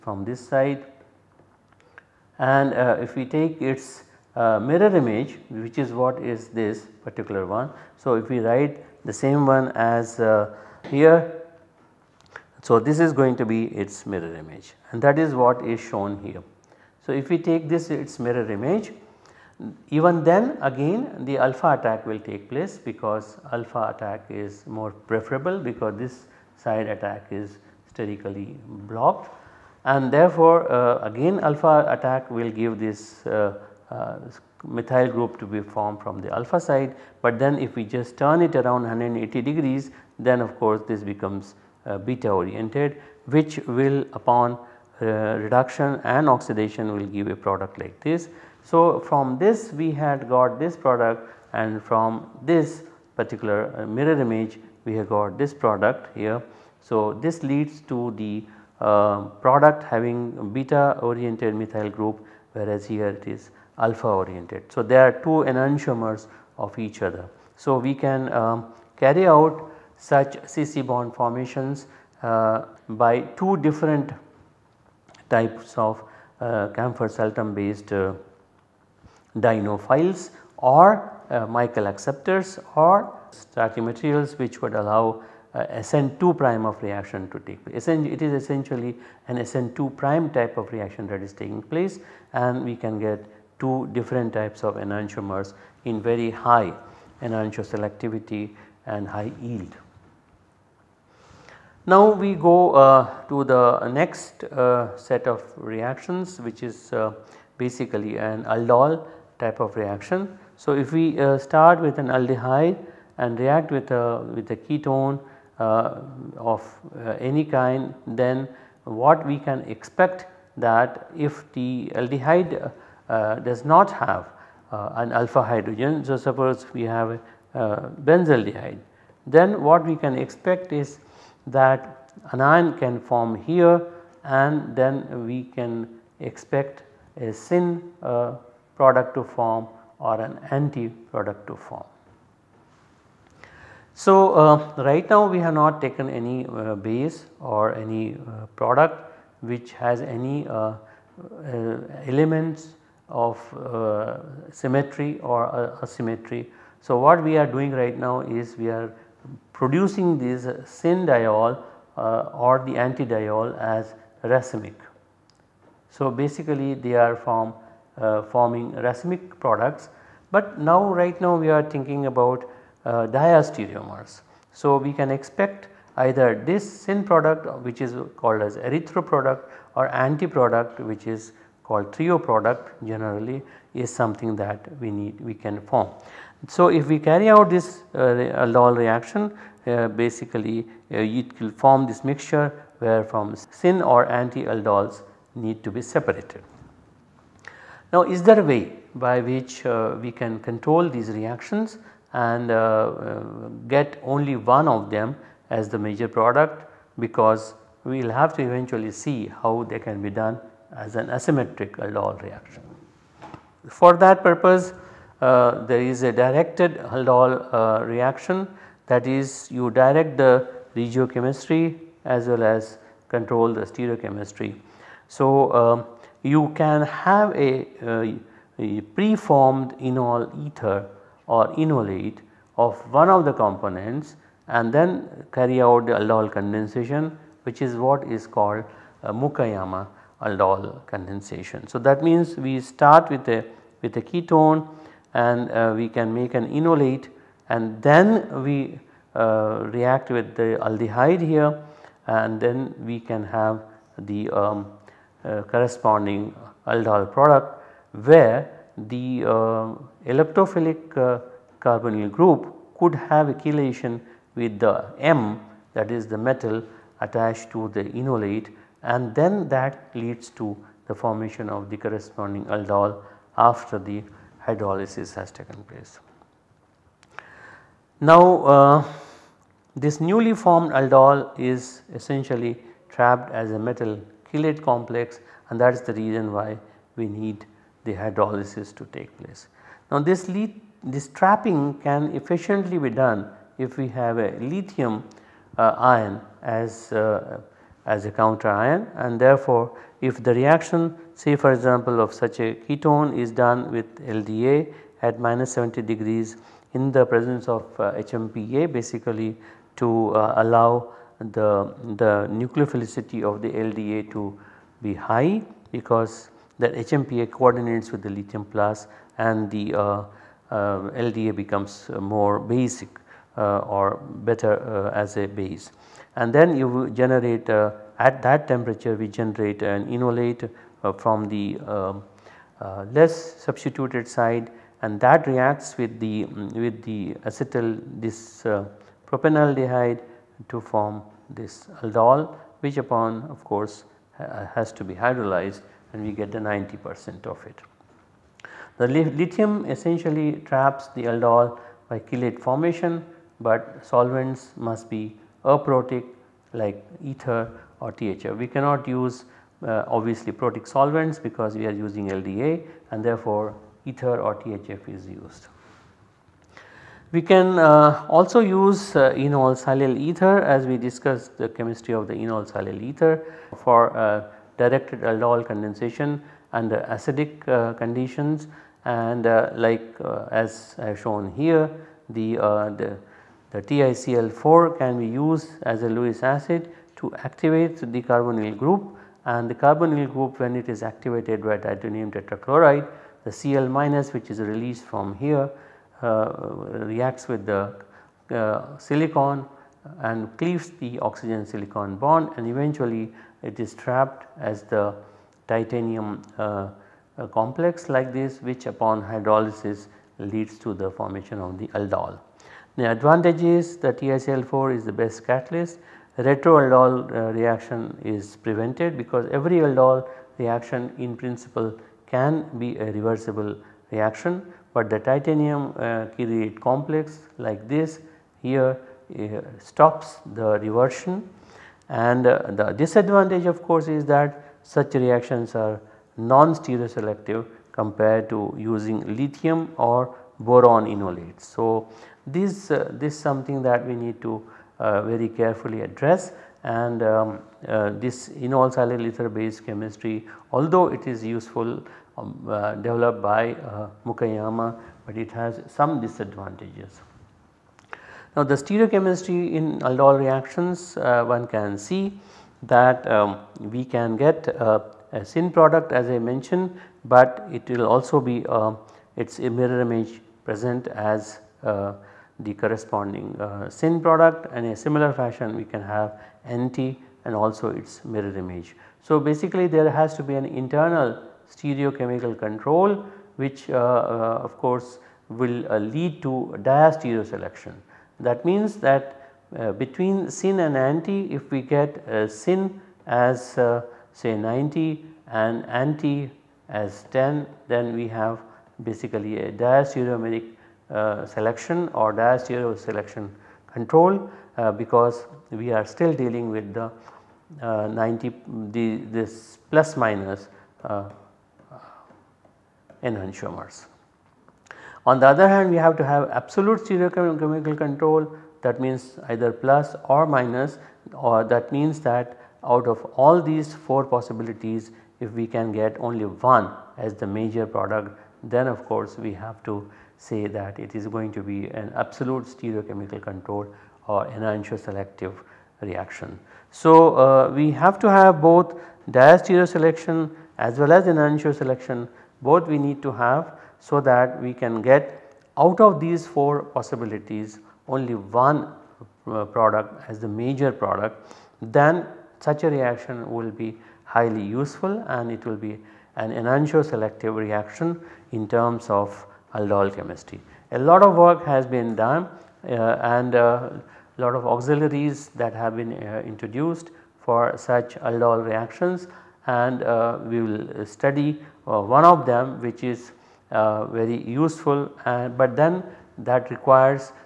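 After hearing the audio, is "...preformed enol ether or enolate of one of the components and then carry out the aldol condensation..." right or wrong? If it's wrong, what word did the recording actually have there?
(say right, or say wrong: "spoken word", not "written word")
right.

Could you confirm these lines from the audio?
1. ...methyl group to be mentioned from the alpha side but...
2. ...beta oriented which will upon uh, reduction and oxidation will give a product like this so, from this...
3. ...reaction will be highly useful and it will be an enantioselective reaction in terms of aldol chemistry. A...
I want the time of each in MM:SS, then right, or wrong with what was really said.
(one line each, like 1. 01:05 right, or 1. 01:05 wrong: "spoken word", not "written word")
1. 00:34 wrong: "formed", not "mentioned"
2. 00:41 right
3. 09:12 right.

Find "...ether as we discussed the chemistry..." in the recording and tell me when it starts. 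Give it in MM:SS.
06:09.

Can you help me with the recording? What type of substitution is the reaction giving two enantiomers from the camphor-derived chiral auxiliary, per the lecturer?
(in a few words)
SN2 prime.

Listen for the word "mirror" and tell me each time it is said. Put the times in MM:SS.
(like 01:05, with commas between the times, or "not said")
00:04, 00:14, 00:18, 00:53, 07:49, 07:58.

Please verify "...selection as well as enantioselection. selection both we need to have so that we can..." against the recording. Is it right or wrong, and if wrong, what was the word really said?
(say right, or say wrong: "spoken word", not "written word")
right.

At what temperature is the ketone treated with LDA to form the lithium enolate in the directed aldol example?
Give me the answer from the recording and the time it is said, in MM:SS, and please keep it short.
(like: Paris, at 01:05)
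-70 degrees, at 05:05.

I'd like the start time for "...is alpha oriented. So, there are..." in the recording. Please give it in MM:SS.
01:03.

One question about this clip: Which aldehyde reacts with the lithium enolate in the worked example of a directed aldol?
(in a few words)
propanaldehyde.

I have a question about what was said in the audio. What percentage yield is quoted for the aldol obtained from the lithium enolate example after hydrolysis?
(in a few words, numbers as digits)
90 percent.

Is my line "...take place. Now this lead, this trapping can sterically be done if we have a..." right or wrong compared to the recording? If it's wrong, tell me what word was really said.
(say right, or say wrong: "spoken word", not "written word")
wrong: "efficiently", not "sterically".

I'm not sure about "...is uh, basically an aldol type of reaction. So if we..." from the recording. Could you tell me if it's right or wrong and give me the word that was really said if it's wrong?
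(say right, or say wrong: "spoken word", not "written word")
right.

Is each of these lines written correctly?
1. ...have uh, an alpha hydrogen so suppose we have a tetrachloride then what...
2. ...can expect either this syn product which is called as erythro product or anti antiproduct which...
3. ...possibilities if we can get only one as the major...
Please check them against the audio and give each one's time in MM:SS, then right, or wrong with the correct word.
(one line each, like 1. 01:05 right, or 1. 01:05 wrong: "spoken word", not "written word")
1. 02:04 wrong: "benzaldehyde", not "tetrachloride"
2. 02:54 wrong: "product", not "antiproduct"
3. 08:44 right.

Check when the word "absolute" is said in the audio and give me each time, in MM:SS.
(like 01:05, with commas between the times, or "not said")
08:36, 08:52.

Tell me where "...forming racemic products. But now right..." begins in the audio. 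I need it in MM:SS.
02:48.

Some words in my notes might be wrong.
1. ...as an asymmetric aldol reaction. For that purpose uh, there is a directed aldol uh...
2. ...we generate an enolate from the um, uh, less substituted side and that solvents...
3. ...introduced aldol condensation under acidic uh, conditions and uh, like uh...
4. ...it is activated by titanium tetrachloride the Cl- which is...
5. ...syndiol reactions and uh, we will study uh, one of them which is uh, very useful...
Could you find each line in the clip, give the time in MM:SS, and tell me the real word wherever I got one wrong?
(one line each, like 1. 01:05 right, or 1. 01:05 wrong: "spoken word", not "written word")
1. 03:30 right
2. 05:28 wrong: "reacts", not "solvents"
3. 06:14 wrong: "directed", not "introduced"
4. 06:30 right
5. 09:28 wrong: "aldol", not "syndiol".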